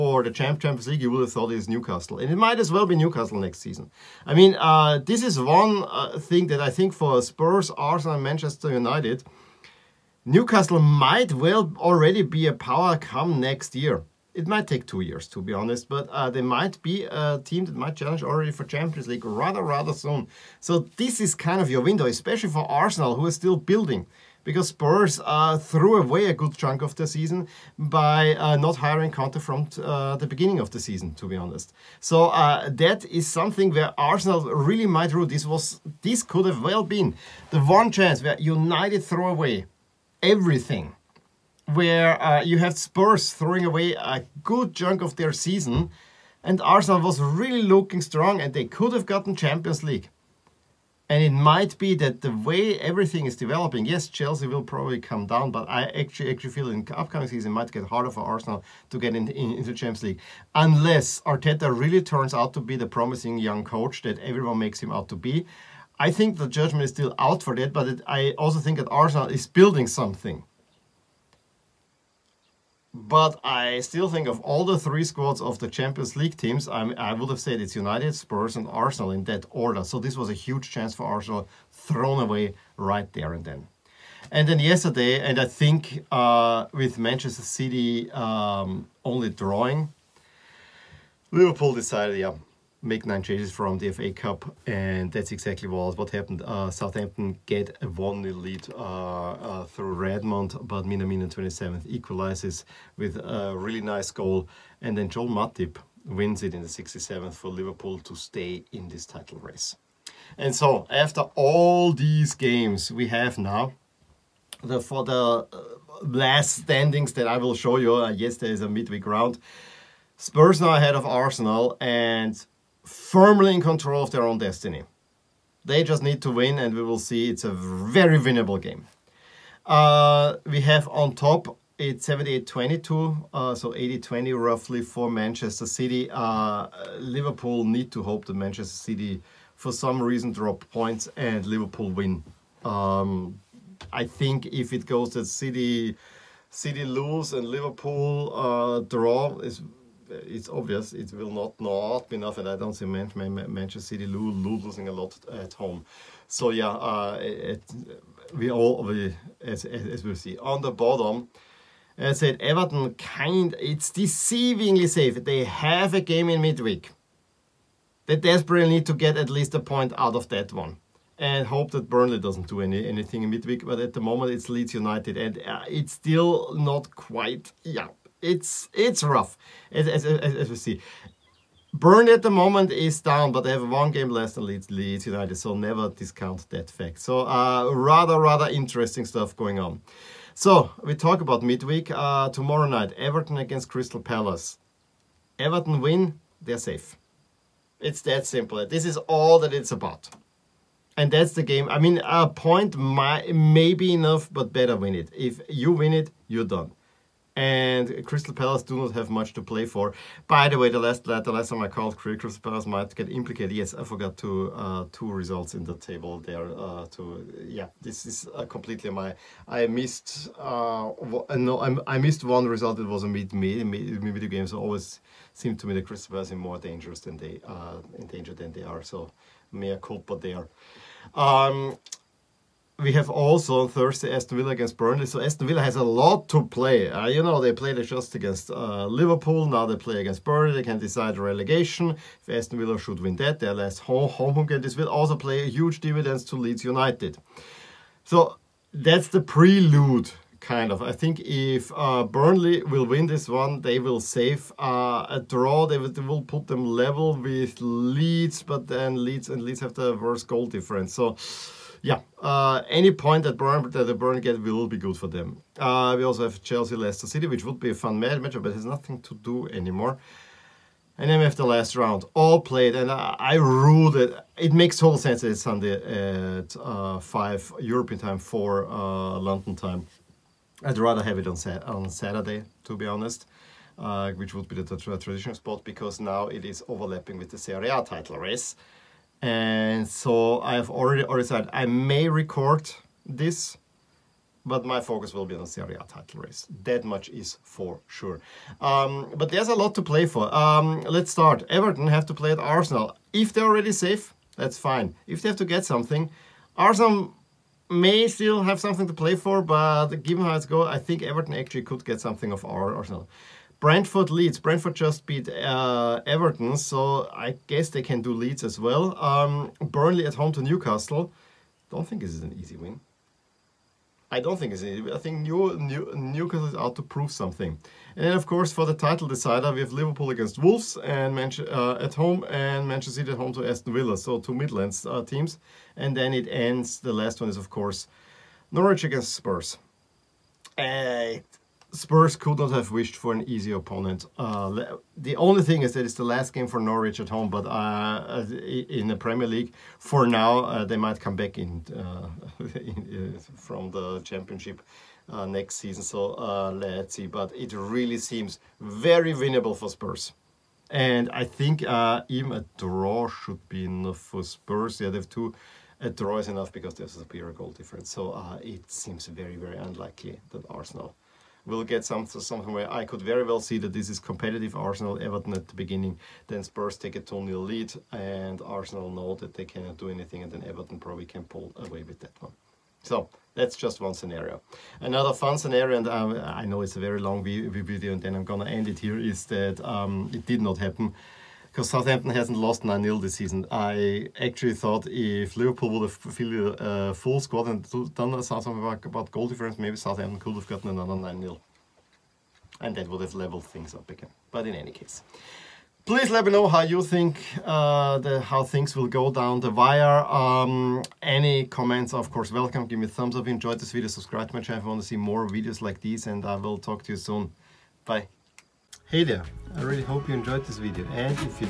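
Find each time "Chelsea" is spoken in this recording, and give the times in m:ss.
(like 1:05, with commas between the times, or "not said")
0:54, 4:26.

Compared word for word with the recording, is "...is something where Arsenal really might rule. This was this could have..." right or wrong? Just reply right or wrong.
right.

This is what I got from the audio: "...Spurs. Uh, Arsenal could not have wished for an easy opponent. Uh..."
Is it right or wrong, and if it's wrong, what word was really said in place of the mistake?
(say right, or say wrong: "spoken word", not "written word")
wrong: "Spurs", not "Arsenal".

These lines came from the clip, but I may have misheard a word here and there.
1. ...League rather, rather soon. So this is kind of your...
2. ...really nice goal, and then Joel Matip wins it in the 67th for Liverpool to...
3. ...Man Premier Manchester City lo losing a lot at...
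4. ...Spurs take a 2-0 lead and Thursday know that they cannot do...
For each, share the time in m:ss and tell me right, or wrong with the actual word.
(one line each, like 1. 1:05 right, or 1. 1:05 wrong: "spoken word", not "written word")
1. 0:19 right
2. 1:43 right
3. 2:32 wrong: "Man", not "Premier"
4. 6:16 wrong: "Arsenal", not "Thursday".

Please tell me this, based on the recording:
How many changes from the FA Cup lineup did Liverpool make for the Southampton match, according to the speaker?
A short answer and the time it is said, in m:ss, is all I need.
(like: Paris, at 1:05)
9, at 1:33.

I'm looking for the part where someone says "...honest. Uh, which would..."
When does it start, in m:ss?
4:42.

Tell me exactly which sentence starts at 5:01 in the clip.
Everton have to play at Arsenal.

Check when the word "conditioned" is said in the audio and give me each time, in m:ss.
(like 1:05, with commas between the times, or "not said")
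not said.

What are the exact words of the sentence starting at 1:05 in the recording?
I think the judgment is still out for that, but it, I also think that Arsenal is building something.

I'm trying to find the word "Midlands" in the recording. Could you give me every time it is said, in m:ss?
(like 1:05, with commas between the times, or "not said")
5:34.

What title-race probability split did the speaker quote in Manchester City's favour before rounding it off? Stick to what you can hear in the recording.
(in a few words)
78-22.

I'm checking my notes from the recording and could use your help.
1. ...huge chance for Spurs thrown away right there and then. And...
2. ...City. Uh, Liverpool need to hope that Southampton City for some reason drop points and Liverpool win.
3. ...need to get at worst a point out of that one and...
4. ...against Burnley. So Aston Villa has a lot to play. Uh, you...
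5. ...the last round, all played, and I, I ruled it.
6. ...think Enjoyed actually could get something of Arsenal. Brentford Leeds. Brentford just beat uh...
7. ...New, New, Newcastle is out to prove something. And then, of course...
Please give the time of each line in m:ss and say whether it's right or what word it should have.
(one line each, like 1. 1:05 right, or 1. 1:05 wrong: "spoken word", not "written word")
1. 1:20 wrong: "Arsenal", not "Spurs"
2. 2:15 wrong: "Manchester", not "Southampton"
3. 2:48 wrong: "least", not "worst"
4. 3:54 right
5. 4:31 right
6. 5:10 wrong: "Everton", not "Enjoyed"
7. 5:25 right.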